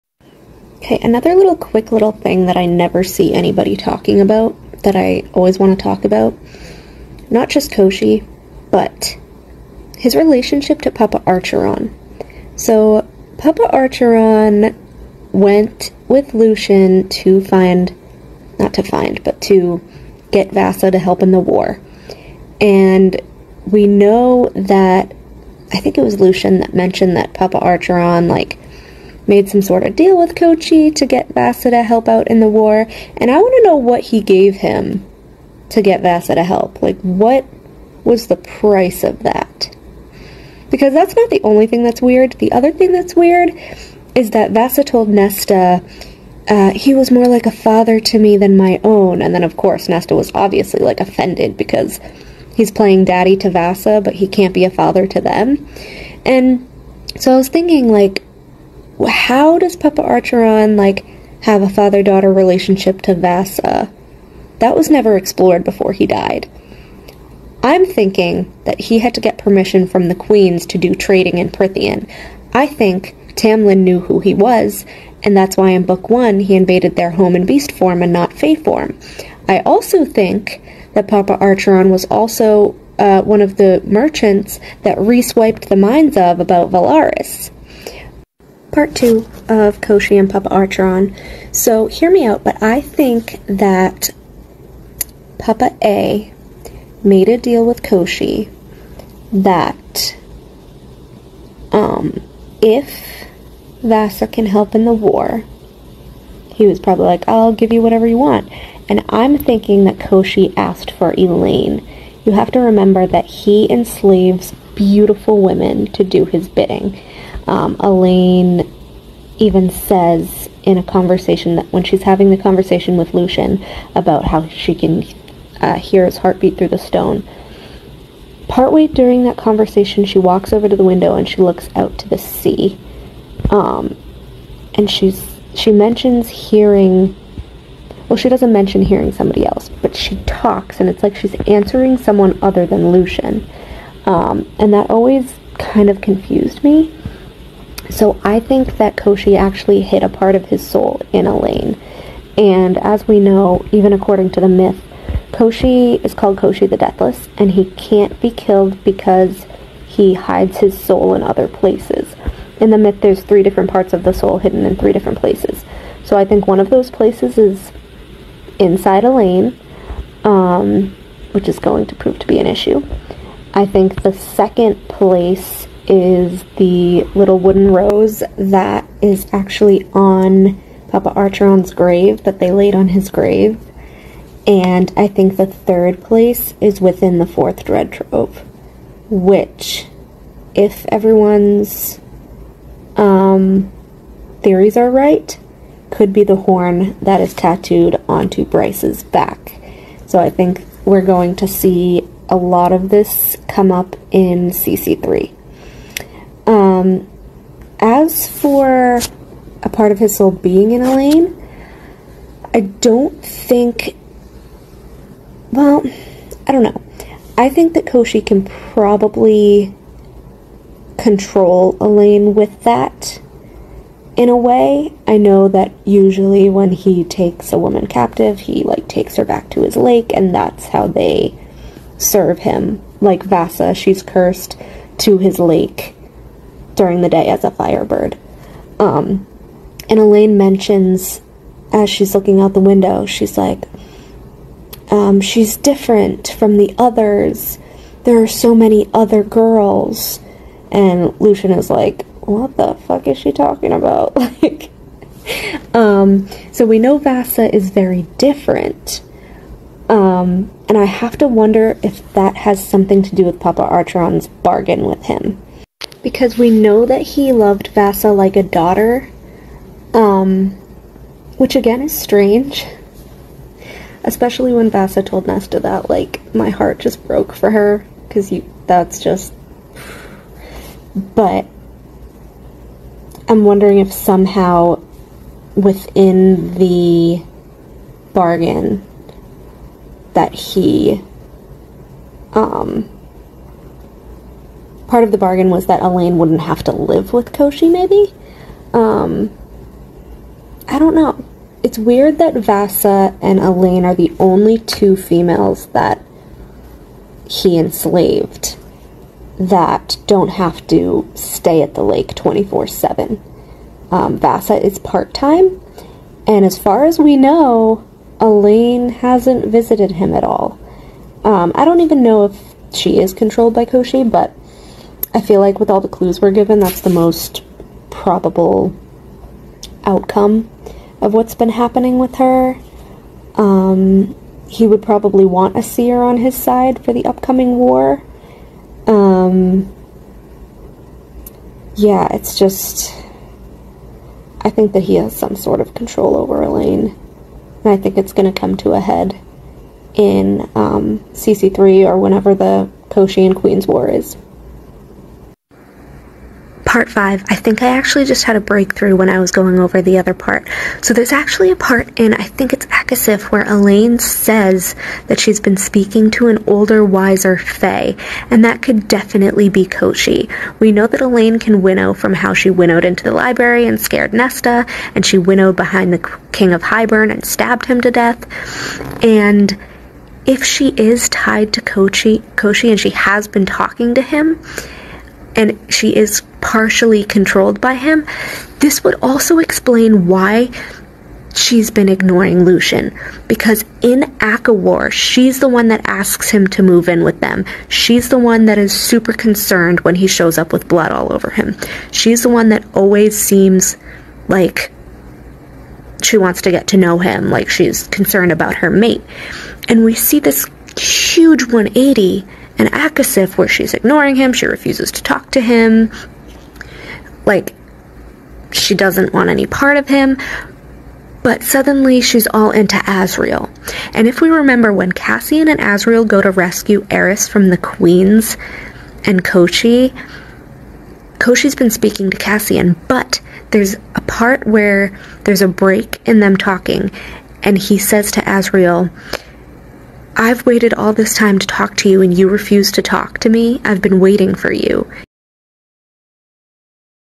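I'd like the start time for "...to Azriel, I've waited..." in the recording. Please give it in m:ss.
7:18.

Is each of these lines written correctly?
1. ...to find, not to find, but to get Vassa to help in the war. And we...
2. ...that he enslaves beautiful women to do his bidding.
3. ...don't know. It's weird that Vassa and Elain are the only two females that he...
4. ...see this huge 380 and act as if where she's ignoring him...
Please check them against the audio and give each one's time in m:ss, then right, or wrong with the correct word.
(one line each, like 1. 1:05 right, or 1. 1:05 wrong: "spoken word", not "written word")
1. 0:17 right
2. 1:53 right
3. 5:00 right
4. 6:49 wrong: "180", not "380".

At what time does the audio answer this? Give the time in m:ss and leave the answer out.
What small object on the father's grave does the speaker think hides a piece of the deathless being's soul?
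2:57.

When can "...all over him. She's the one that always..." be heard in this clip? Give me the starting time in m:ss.
6:40.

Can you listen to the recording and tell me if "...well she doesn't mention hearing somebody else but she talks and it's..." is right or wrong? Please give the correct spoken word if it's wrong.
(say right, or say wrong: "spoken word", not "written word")
right.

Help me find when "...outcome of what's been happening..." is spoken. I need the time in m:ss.
5:29.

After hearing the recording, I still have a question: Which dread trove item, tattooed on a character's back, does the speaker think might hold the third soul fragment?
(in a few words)
the horn.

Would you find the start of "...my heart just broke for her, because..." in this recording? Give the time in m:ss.
4:36.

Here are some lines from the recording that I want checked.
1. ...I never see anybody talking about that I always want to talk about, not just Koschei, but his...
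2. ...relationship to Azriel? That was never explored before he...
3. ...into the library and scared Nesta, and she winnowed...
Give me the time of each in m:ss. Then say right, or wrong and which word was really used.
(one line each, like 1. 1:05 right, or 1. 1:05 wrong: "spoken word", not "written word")
1. 0:02 right
2. 1:02 wrong: "Vassa", not "Azriel"
3. 6:12 right.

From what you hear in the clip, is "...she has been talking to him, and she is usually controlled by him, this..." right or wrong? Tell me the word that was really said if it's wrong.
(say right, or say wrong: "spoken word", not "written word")
wrong: "partially", not "usually".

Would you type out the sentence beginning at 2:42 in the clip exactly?
In the myth, there's three different parts of the soul hidden in three different places.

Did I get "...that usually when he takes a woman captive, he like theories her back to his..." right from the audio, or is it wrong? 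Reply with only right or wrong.
wrong.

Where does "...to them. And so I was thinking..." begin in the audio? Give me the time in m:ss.
0:55.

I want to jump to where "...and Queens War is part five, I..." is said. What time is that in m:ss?
5:53.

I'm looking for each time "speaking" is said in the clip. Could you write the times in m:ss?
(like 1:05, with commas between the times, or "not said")
6:05, 7:11.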